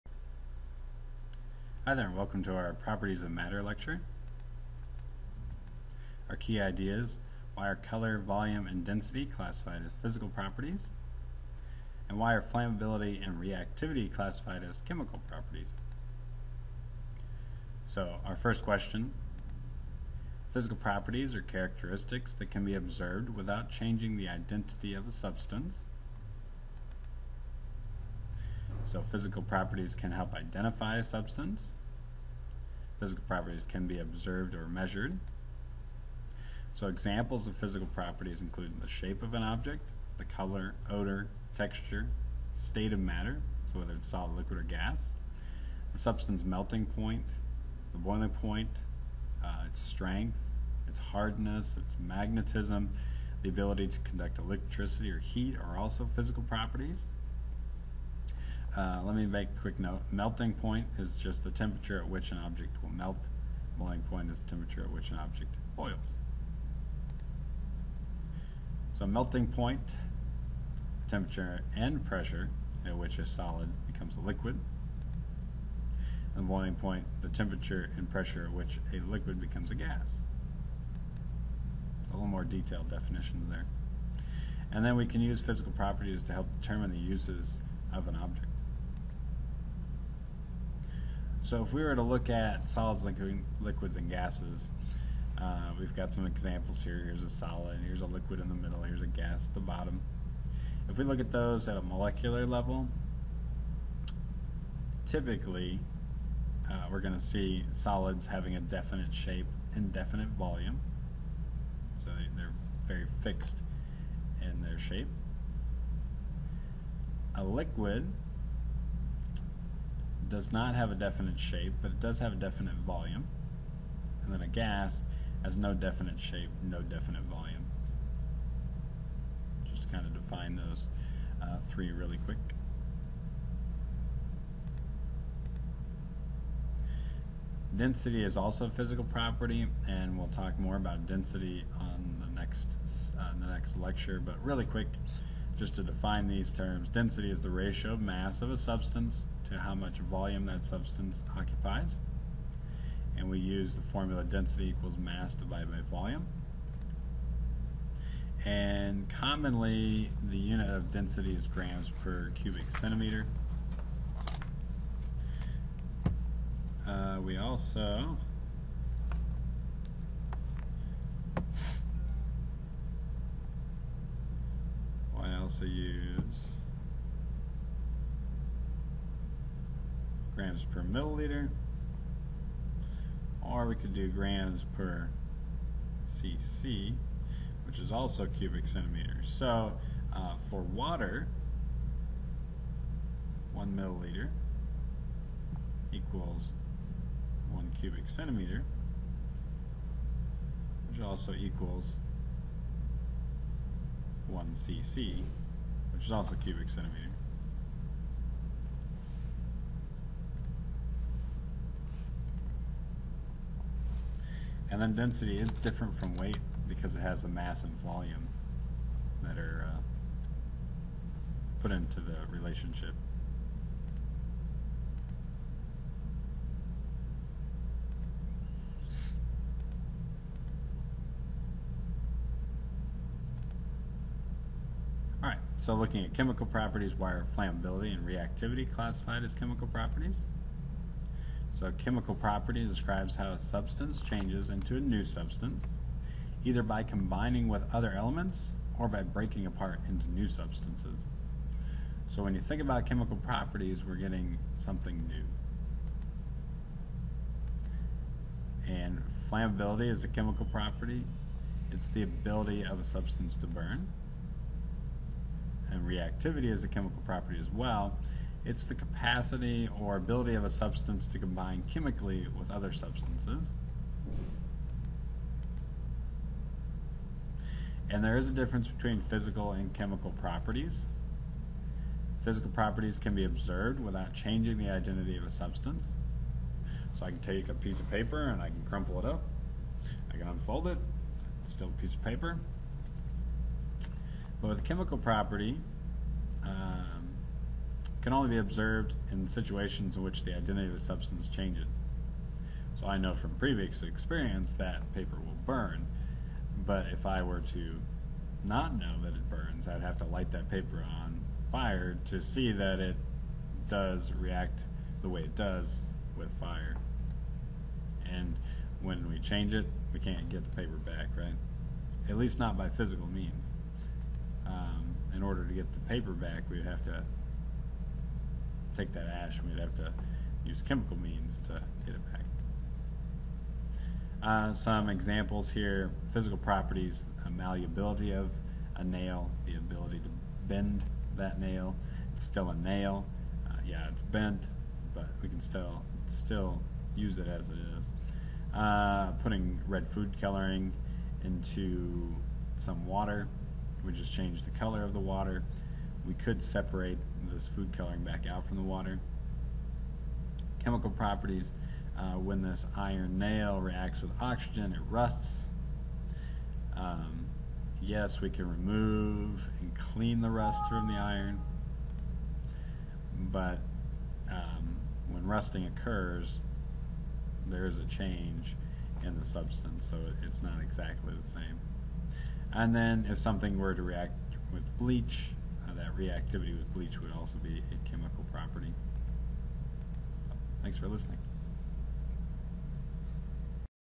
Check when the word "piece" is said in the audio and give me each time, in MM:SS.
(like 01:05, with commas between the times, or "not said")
04:47, 04:51.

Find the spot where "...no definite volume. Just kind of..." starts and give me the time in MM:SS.
02:06.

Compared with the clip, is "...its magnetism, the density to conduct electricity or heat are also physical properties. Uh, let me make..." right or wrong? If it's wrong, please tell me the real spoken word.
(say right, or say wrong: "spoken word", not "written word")
wrong: "ability", not "density".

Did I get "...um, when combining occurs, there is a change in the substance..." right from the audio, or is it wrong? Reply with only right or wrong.
wrong.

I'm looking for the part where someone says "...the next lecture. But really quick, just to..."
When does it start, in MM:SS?
02:23.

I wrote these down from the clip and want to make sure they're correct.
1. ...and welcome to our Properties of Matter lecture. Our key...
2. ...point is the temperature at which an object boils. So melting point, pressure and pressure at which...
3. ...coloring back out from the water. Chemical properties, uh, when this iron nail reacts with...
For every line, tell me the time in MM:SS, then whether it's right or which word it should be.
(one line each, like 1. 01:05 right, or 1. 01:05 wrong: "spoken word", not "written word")
1. 00:02 right
2. 01:04 wrong: "temperature", not "pressure"
3. 05:57 right.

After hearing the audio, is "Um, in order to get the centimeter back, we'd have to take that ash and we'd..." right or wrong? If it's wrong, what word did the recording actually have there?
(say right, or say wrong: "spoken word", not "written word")
wrong: "paper", not "centimeter".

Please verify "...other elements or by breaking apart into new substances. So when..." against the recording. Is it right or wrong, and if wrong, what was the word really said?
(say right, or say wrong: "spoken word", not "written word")
right.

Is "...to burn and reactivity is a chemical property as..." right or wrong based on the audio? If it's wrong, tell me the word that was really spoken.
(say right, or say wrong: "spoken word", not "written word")
right.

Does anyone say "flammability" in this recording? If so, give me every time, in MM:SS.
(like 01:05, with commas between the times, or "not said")
00:12, 03:57, 04:19.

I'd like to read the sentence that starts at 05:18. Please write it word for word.
And when we change it, we can't get the paper back, right?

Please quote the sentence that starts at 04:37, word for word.
And there is a difference between physical and chemical properties.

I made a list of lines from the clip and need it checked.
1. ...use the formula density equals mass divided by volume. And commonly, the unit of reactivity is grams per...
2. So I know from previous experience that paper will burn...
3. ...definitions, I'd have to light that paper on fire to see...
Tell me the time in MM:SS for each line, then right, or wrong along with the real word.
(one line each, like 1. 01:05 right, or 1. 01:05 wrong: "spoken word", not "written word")
1. 02:33 wrong: "density", not "reactivity"
2. 05:02 right
3. 05:09 wrong: "burns", not "definitions".